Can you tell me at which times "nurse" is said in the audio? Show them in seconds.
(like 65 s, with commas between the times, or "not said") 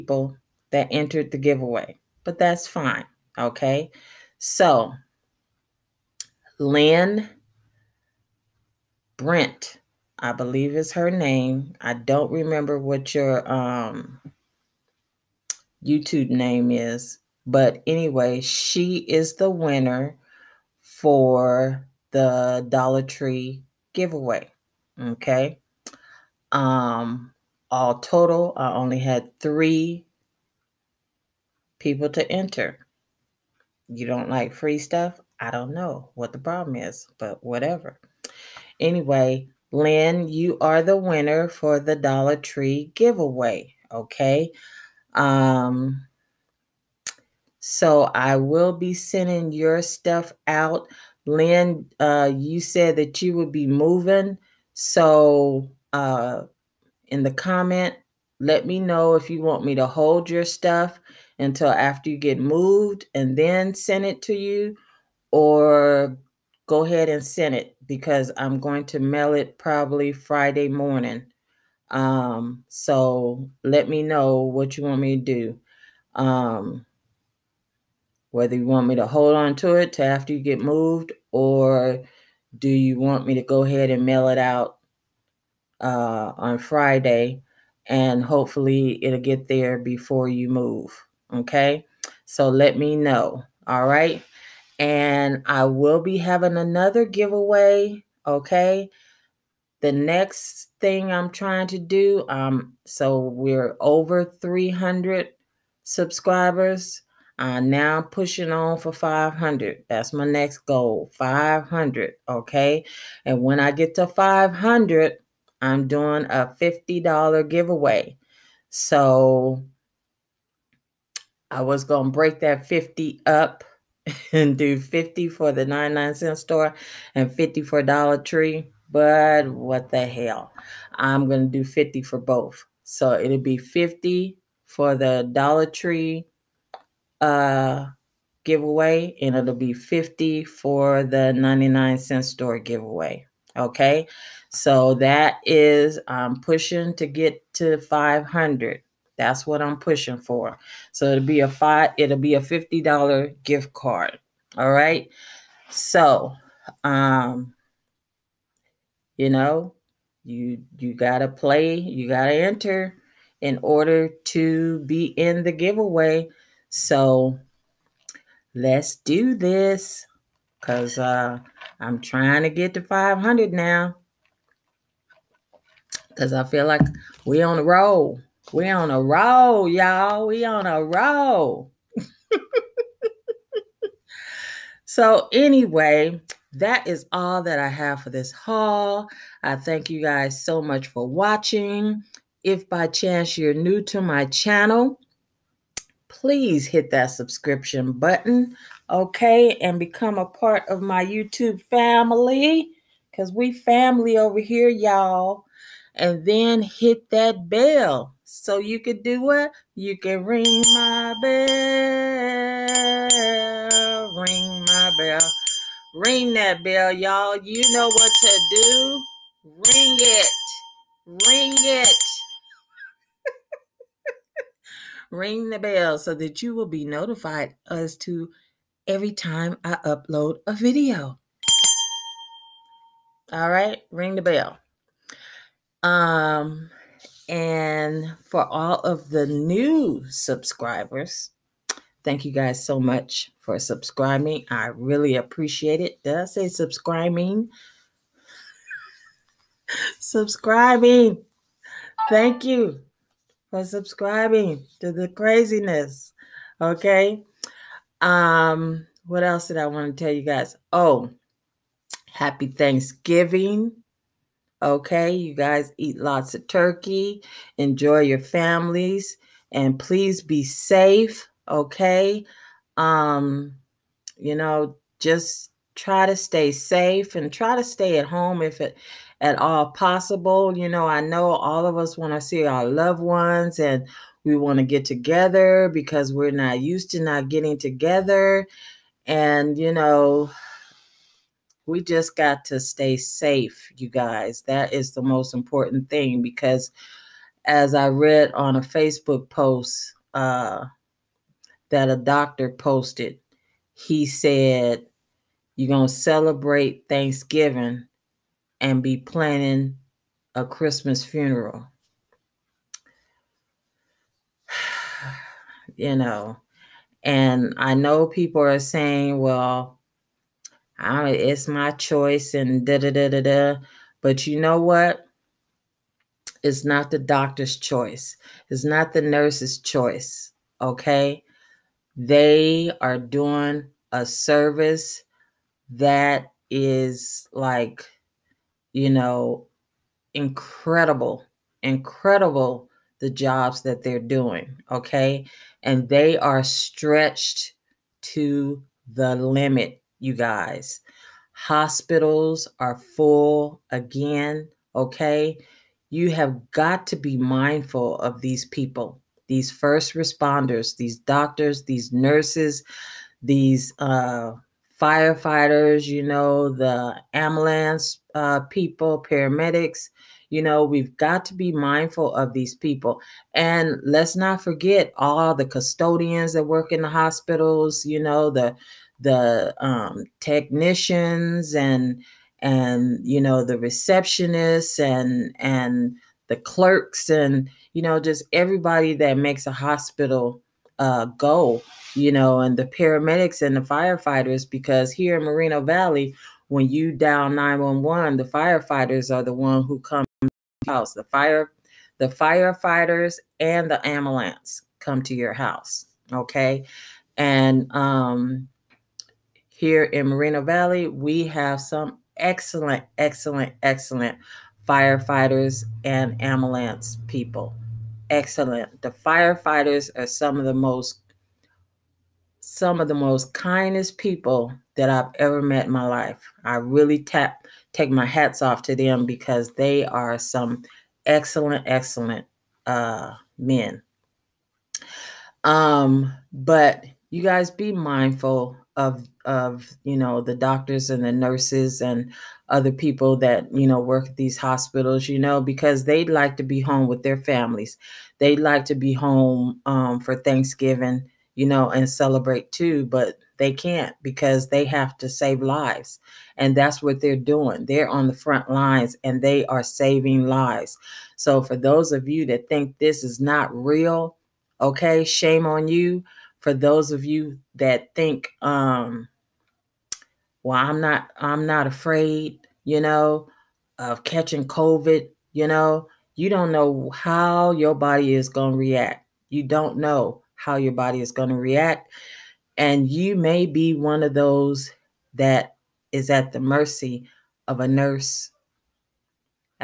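329 s, 361 s, 441 s, 487 s.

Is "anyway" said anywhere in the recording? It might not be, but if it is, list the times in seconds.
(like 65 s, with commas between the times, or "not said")
17 s, 38 s, 185 s.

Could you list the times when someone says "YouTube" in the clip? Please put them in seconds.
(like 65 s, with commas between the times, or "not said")
15 s, 201 s.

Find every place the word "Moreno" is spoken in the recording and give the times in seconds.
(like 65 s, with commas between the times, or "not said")
395 s, 410 s.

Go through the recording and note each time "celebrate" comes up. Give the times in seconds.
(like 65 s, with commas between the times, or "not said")
305 s, 451 s.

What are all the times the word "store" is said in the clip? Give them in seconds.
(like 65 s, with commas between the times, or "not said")
126 s, 142 s.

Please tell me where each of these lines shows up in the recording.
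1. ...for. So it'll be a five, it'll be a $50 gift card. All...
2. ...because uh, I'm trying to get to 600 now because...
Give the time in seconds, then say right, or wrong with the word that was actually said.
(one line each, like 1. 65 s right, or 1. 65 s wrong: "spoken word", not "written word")
1. 150 s right
2. 170 s wrong: "500", not "600".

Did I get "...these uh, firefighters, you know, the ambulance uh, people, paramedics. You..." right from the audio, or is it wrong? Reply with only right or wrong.
right.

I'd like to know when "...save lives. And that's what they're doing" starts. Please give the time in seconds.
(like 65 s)
455 s.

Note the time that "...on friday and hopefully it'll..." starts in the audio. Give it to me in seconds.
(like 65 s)
86 s.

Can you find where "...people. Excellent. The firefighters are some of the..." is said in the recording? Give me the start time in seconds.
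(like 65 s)
417 s.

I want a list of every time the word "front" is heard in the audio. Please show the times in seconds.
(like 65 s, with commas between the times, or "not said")
458 s.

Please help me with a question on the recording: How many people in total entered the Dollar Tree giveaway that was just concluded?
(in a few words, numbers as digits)
3.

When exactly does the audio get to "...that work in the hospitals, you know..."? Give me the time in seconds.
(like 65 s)
376 s.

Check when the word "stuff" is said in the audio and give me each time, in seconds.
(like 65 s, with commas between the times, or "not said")
34 s, 49 s, 60 s.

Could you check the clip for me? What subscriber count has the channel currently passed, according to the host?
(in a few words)
300.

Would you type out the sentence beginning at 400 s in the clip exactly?
The fire, the firefighters and the ambulance come to your house.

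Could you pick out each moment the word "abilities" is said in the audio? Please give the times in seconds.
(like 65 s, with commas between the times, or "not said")
not said.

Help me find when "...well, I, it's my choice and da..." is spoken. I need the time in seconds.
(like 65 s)
319 s.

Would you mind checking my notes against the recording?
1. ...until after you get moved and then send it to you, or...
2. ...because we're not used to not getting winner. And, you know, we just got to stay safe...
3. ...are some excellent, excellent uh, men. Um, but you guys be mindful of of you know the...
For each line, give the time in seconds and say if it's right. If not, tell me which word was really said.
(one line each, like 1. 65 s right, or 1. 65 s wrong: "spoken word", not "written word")
1. 61 s right
2. 285 s wrong: "together", not "winner"
3. 429 s right.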